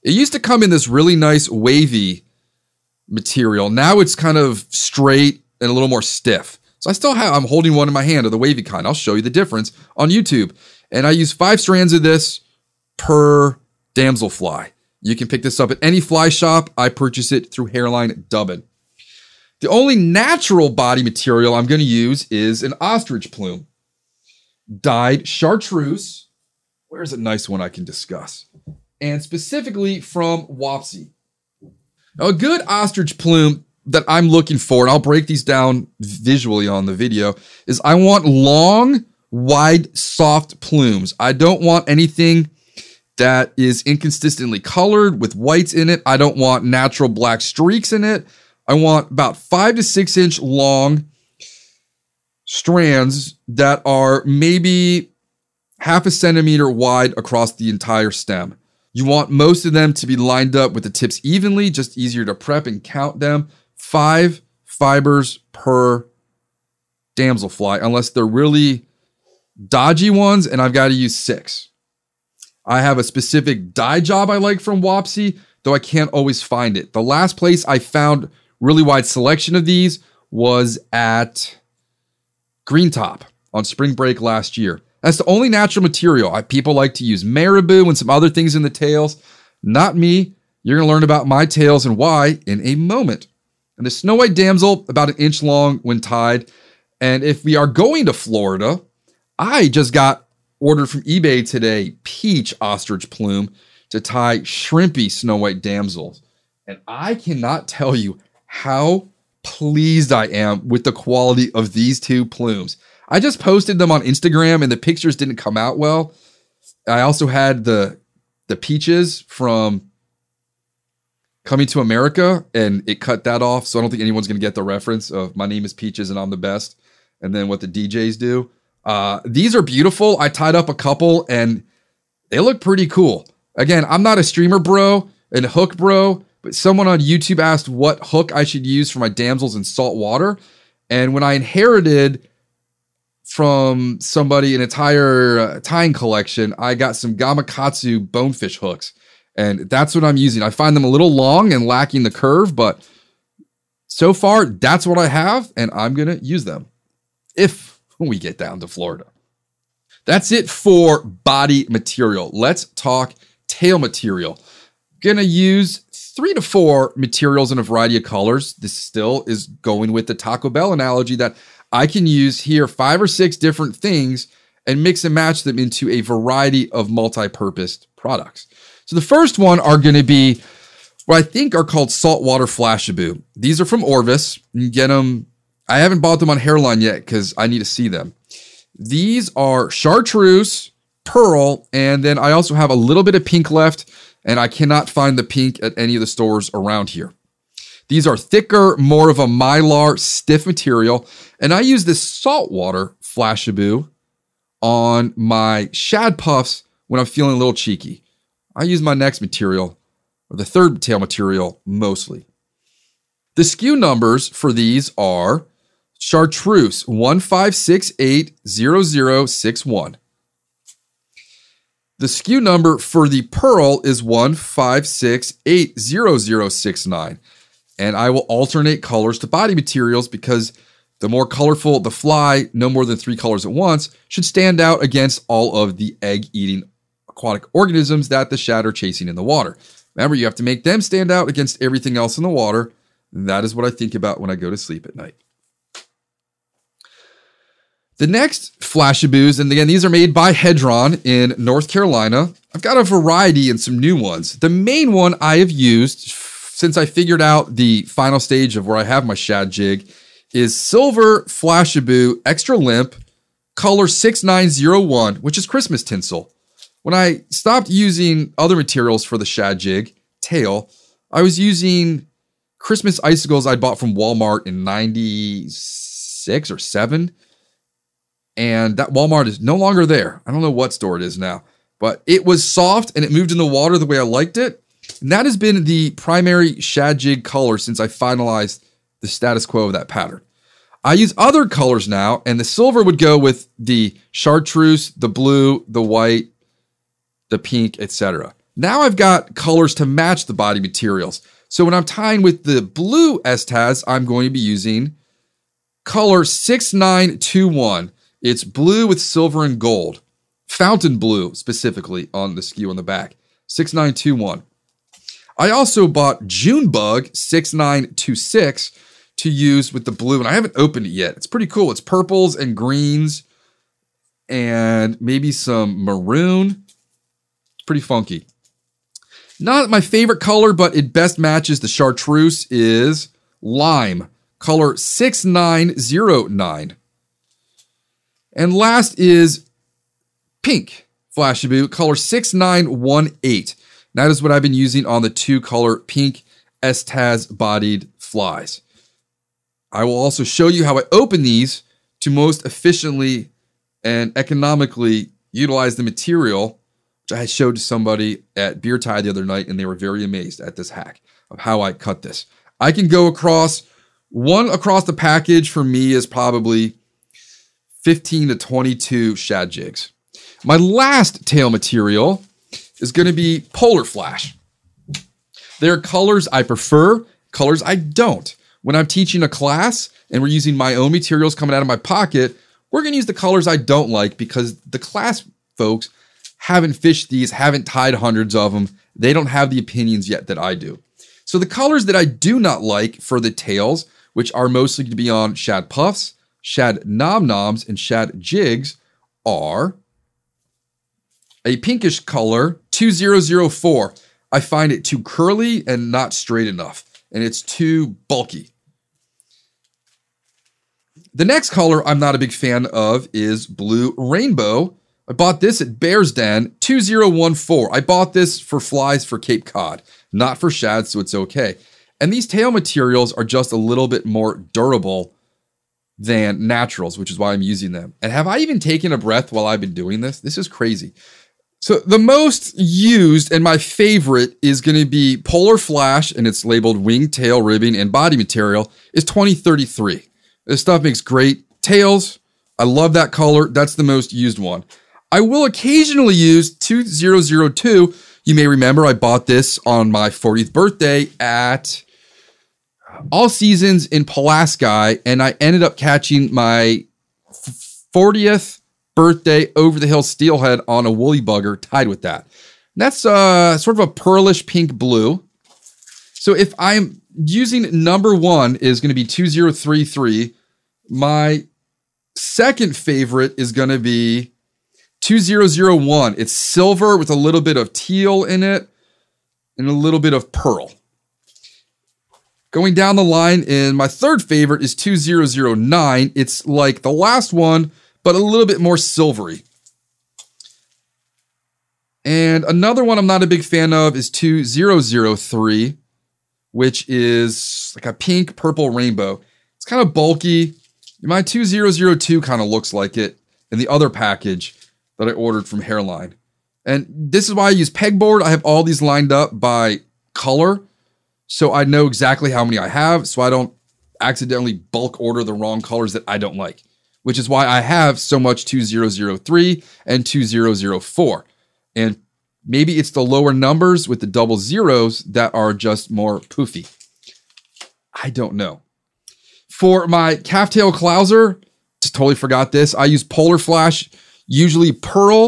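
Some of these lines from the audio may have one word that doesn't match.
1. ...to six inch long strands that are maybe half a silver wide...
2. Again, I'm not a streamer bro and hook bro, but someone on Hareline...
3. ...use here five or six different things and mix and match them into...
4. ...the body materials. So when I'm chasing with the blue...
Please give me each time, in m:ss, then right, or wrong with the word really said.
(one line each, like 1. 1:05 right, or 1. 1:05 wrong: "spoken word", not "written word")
1. 0:49 wrong: "centimeter", not "silver"
2. 2:13 wrong: "YouTube", not "Hareline"
3. 2:52 right
4. 5:00 wrong: "tying", not "chasing".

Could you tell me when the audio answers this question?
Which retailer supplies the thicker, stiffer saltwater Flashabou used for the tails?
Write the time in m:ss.
3:03.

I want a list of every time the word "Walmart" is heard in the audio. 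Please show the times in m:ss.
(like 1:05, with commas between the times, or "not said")
4:33, 4:38.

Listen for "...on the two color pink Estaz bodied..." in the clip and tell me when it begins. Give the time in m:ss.
5:44.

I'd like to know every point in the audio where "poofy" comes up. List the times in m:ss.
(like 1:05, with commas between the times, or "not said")
8:46.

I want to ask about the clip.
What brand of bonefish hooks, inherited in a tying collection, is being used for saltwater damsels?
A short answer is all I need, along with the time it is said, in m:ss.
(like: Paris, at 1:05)
Gamakatsu, at 2:27.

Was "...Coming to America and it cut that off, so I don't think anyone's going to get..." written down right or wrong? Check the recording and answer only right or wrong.
right.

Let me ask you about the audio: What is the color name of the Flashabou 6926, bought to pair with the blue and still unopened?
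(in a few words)
Junebug.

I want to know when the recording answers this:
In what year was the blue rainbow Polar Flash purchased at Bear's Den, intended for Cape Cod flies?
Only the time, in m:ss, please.
6:56.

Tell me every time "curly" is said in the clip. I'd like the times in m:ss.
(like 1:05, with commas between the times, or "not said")
6:45.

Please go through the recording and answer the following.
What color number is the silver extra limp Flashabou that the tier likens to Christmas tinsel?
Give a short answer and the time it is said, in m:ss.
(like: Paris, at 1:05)
6901, at 4:23.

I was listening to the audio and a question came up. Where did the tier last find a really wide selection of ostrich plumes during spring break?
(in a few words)
Green Top.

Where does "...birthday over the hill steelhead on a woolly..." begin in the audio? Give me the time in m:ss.
7:38.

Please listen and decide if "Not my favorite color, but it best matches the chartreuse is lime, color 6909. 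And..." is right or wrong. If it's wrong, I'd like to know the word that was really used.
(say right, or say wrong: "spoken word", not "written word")
right.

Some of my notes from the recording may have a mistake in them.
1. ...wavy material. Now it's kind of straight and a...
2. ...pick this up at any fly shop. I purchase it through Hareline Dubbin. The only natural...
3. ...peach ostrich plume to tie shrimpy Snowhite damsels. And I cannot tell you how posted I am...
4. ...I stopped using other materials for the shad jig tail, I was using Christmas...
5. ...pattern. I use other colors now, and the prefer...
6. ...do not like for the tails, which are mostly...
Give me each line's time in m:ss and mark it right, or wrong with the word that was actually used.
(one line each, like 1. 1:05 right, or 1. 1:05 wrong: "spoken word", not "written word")
1. 0:01 right
2. 0:15 right
3. 1:42 wrong: "pleased", not "posted"
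4. 4:26 right
5. 4:49 wrong: "silver", not "prefer"
6. 6:32 right.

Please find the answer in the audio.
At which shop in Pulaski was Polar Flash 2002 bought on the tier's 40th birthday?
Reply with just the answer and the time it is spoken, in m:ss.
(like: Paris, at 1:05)
All Seasons, at 7:33.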